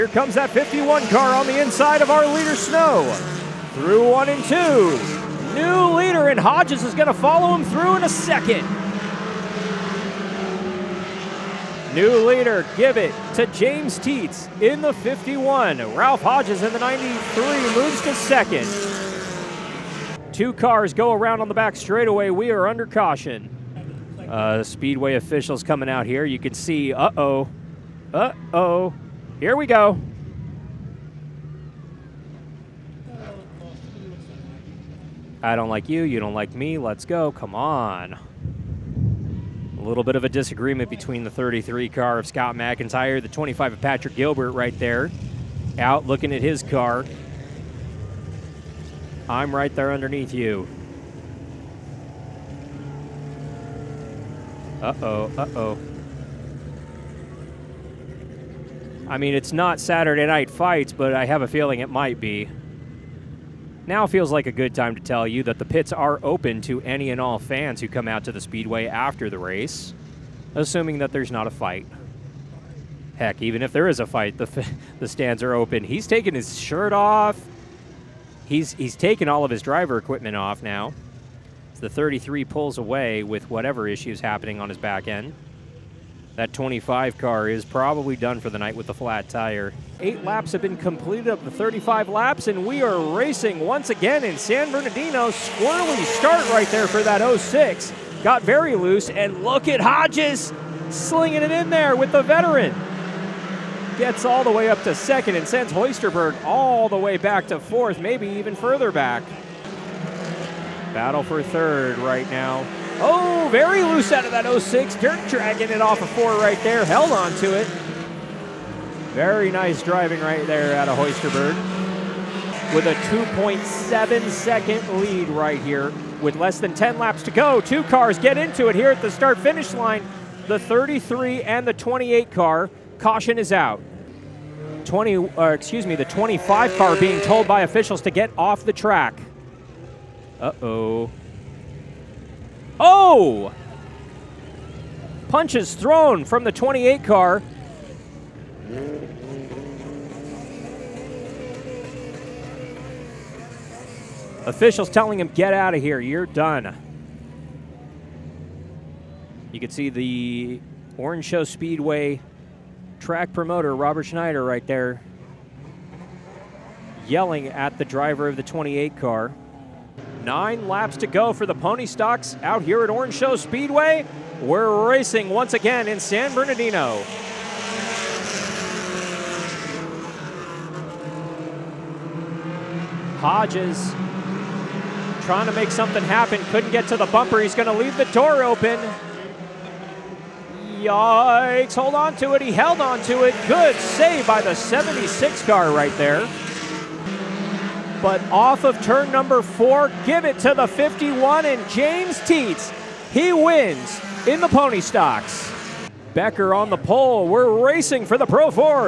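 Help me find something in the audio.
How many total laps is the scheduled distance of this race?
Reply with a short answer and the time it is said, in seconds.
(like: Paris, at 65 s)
35, at 91 s.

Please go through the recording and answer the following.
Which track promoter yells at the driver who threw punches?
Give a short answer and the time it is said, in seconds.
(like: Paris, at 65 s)
Robert Schneider, at 163 s.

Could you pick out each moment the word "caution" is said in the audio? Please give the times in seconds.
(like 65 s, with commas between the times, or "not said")
22 s, 132 s.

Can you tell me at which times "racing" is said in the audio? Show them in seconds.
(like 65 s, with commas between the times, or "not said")
92 s, 174 s, 207 s.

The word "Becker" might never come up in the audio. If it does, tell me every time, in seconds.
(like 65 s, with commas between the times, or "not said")
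206 s.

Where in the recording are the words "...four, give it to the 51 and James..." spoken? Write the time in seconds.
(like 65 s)
199 s.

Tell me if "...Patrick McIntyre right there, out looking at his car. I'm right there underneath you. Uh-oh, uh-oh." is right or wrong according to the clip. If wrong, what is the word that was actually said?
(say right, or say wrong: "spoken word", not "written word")
wrong: "Gilbert", not "McIntyre".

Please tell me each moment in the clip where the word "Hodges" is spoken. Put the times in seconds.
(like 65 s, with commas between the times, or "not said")
6 s, 16 s, 99 s, 183 s.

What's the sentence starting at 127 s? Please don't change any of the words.
Two cars get into it here at the start finish line.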